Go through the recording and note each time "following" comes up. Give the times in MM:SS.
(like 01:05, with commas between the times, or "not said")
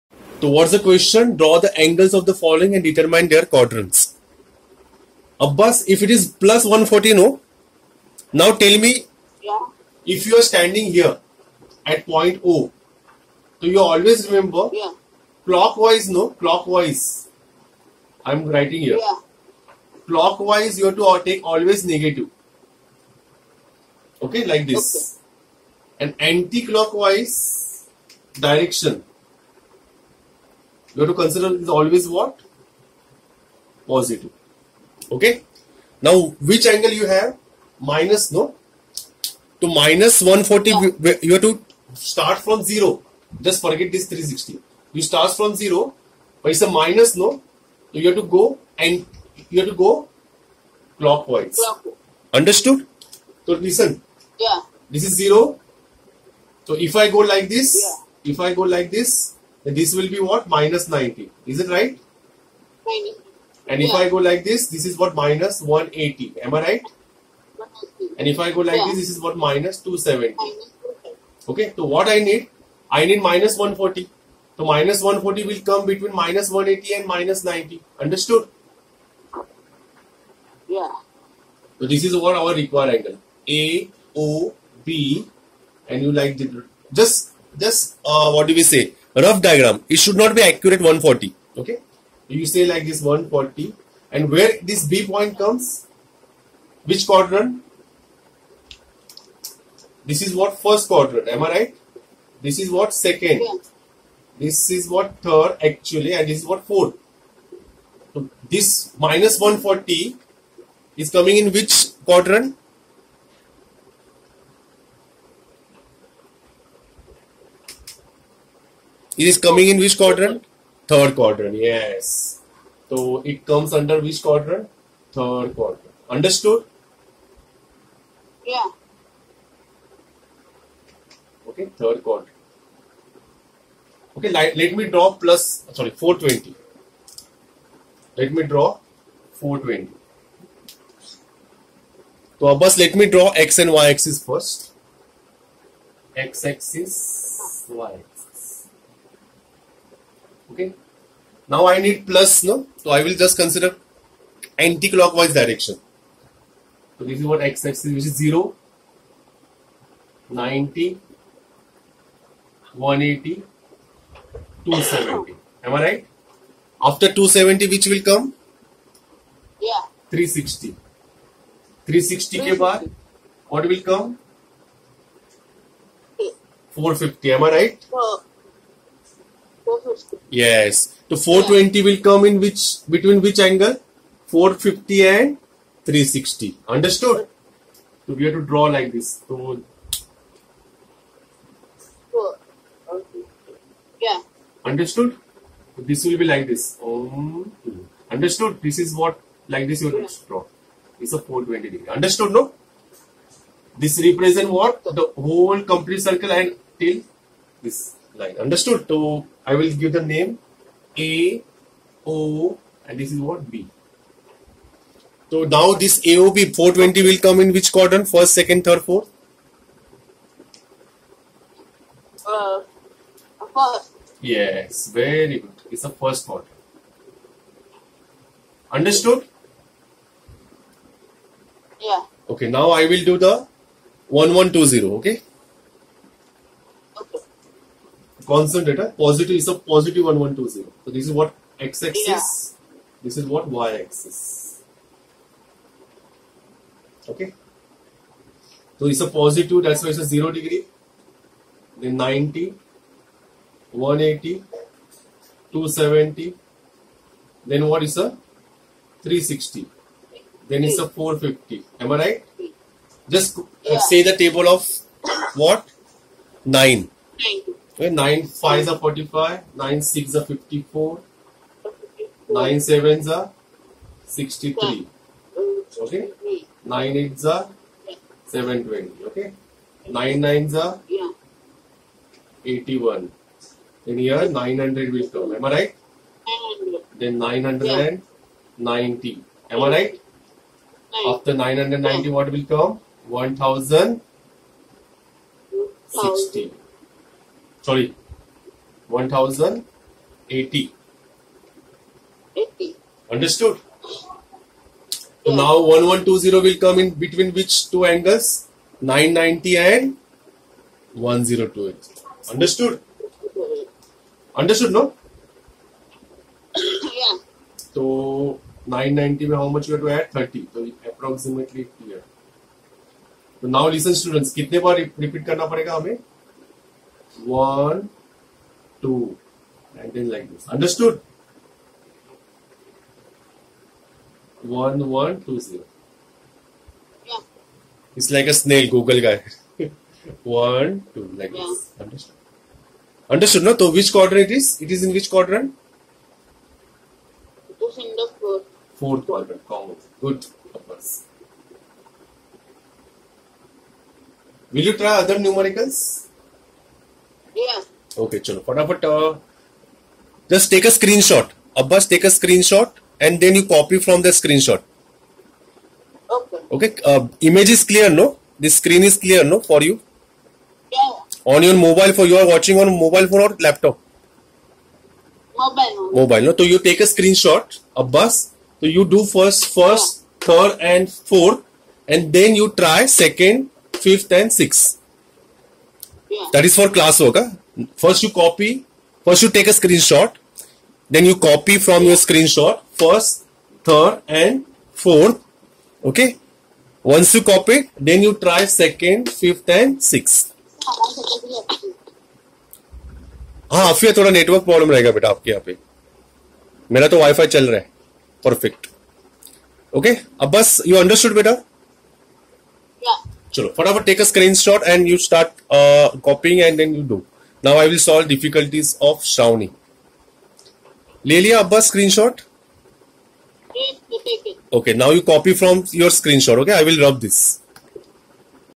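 00:02.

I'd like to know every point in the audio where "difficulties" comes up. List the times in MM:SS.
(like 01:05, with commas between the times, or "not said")
06:58.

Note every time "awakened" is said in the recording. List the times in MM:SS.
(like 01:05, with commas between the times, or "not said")
not said.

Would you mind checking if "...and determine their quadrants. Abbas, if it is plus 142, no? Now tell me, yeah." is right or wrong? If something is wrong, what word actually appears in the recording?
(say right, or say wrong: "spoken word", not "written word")
wrong: "140", not "142".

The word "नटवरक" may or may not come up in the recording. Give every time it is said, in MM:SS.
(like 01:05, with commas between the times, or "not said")
06:44.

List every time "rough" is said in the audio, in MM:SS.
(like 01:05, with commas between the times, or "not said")
01:29.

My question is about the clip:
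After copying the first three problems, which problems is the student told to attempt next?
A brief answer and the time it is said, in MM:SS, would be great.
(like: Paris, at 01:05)
Second, fifth and sixth, at 06:38.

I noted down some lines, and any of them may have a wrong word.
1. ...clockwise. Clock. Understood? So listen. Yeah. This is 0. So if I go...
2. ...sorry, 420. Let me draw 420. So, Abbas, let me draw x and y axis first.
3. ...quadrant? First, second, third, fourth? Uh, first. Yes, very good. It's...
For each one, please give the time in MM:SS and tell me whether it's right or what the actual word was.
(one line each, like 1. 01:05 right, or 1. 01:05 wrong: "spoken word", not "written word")
1. 00:50 right
2. 02:15 right
3. 03:37 right.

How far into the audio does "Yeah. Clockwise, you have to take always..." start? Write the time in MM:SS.
00:18.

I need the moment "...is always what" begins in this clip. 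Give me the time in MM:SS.
00:31.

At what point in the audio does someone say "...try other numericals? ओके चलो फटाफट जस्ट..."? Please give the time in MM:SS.
05:54.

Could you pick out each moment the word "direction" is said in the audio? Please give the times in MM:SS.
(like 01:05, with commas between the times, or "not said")
00:28, 02:35.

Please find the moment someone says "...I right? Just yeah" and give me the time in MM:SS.
04:21.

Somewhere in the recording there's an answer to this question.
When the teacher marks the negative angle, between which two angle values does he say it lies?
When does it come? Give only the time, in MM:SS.
01:15.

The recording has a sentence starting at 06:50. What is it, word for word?
अब बस यू अंडरस्टूड बेटा yeah.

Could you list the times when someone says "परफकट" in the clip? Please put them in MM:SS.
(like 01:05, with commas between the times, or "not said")
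06:48.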